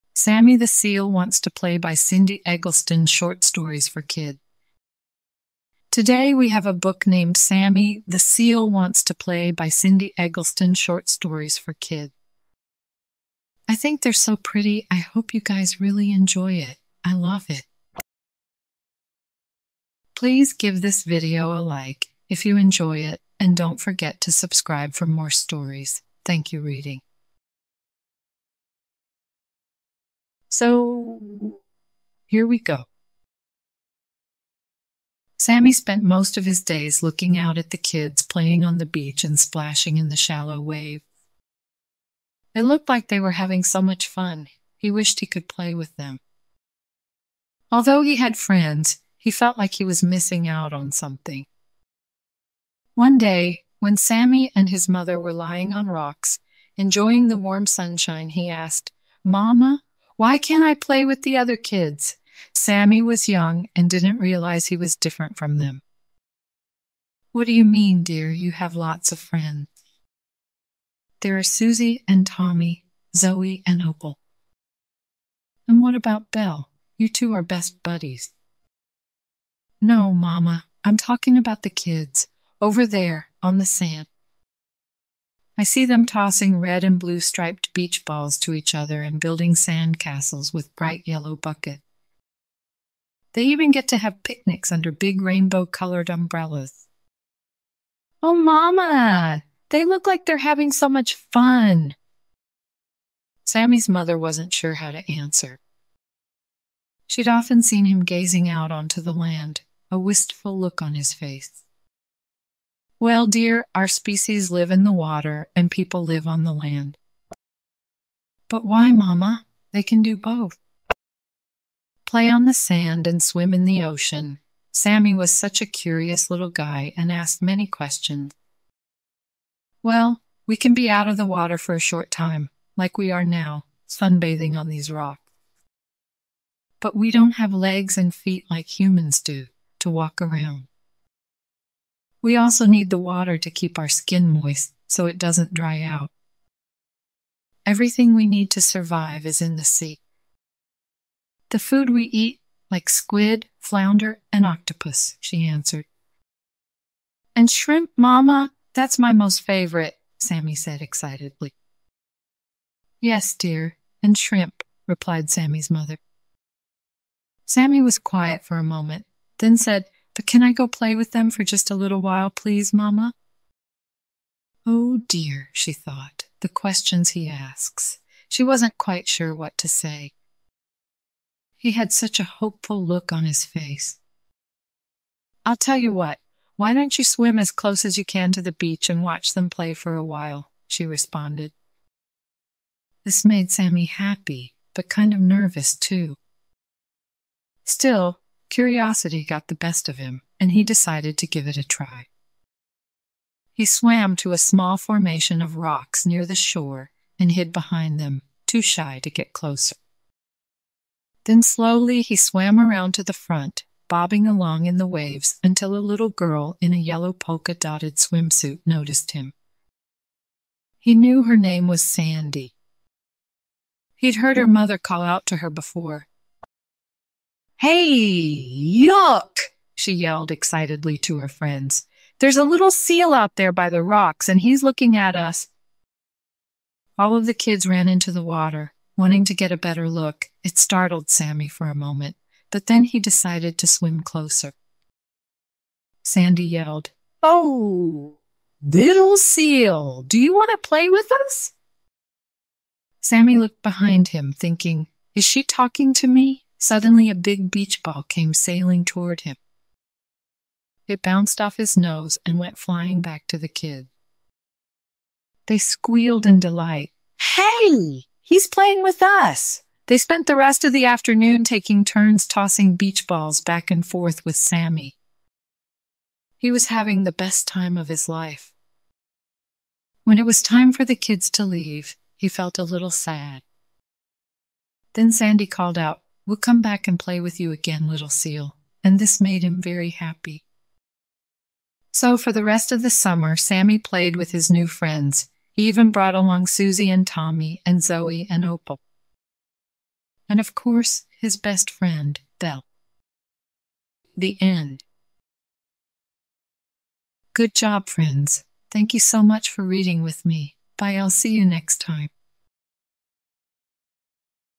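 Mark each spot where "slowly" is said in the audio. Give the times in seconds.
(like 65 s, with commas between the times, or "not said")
211 s.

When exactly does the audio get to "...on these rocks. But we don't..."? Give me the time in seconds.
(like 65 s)
134 s.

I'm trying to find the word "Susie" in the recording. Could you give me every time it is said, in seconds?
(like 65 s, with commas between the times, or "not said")
71 s, 296 s.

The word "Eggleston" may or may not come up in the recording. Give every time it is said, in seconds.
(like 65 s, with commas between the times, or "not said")
2 s, 10 s.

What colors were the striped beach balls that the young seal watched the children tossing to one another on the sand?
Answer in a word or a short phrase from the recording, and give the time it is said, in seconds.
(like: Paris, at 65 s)
red and blue, at 86 s.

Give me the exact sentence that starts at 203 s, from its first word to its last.
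He swam to a small formation of rocks near the shore and hid behind them, too shy to get closer.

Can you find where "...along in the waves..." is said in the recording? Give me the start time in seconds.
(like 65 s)
214 s.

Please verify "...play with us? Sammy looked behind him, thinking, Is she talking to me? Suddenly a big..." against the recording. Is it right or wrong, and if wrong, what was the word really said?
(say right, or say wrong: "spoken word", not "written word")
right.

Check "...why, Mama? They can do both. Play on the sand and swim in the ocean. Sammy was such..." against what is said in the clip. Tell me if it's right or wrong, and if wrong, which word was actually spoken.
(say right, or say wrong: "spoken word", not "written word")
right.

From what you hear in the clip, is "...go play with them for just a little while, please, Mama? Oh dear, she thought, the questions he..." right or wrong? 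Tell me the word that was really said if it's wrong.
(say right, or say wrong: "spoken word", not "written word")
right.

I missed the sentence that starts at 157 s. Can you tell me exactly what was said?
And shrimp, Mama, that's my most favorite, Sammy said excitedly.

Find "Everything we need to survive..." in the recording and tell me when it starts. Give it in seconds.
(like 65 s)
147 s.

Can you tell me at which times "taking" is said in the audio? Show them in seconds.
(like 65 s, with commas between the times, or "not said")
271 s.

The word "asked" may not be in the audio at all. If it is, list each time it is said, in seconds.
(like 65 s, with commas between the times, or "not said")
58 s, 127 s.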